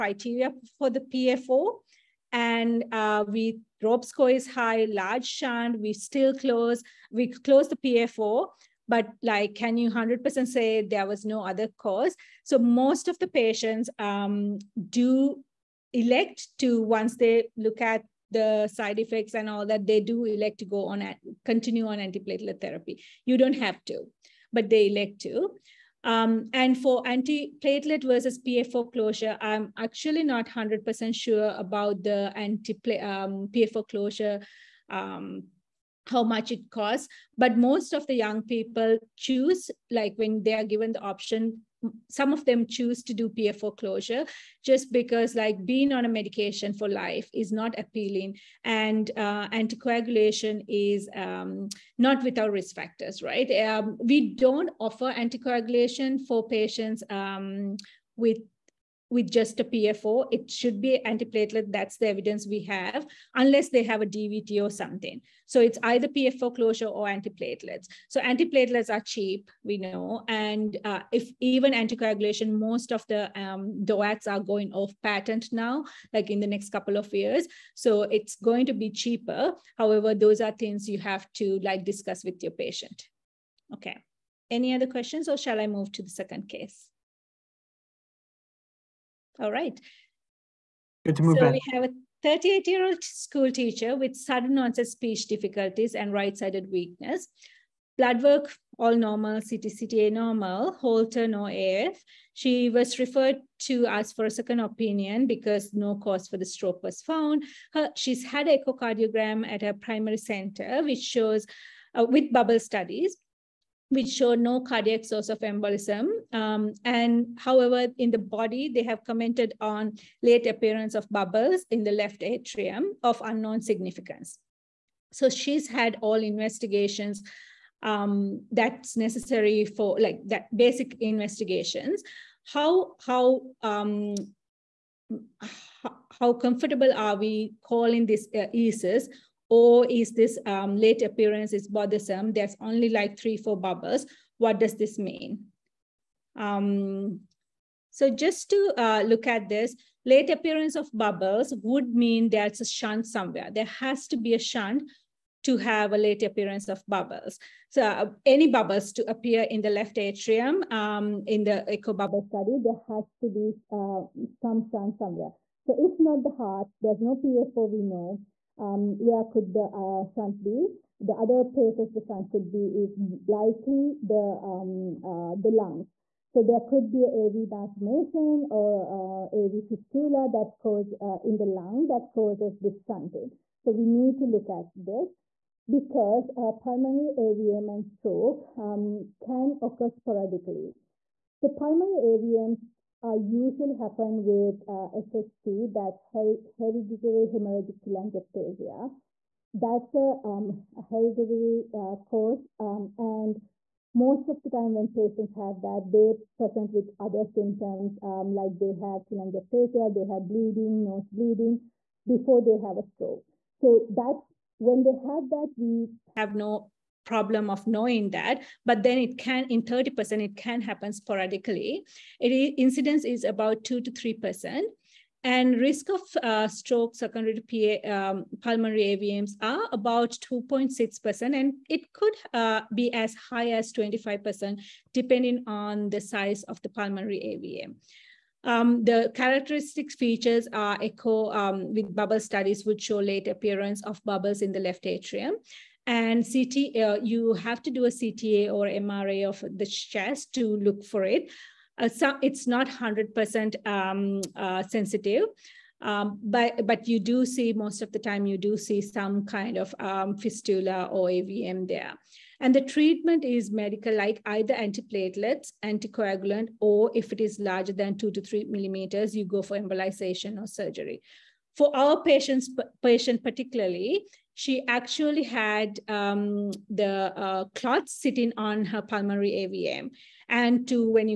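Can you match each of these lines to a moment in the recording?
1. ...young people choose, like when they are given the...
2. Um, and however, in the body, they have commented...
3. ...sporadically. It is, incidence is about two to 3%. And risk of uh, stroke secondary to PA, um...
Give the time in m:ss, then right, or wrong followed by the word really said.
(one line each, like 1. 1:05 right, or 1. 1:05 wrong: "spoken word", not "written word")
1. 0:38 right
2. 1:56 right
3. 3:40 right.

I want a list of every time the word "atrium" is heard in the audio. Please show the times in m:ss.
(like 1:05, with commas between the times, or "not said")
2:02, 2:39, 4:04.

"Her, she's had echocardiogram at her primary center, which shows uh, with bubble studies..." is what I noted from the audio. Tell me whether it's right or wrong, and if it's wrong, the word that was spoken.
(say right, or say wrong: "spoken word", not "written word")
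right.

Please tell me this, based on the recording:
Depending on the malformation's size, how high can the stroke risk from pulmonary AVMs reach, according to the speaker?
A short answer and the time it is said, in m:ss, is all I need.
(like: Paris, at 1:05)
25%, at 3:53.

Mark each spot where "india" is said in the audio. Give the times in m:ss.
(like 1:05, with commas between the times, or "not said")
not said.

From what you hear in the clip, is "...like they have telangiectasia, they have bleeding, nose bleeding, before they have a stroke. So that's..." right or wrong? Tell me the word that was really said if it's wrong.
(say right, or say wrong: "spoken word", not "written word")
right.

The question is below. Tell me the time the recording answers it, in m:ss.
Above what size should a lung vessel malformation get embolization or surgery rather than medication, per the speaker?
4:27.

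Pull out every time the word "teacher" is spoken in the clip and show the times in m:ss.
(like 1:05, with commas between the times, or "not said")
1:33.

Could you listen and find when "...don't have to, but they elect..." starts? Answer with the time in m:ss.
0:23.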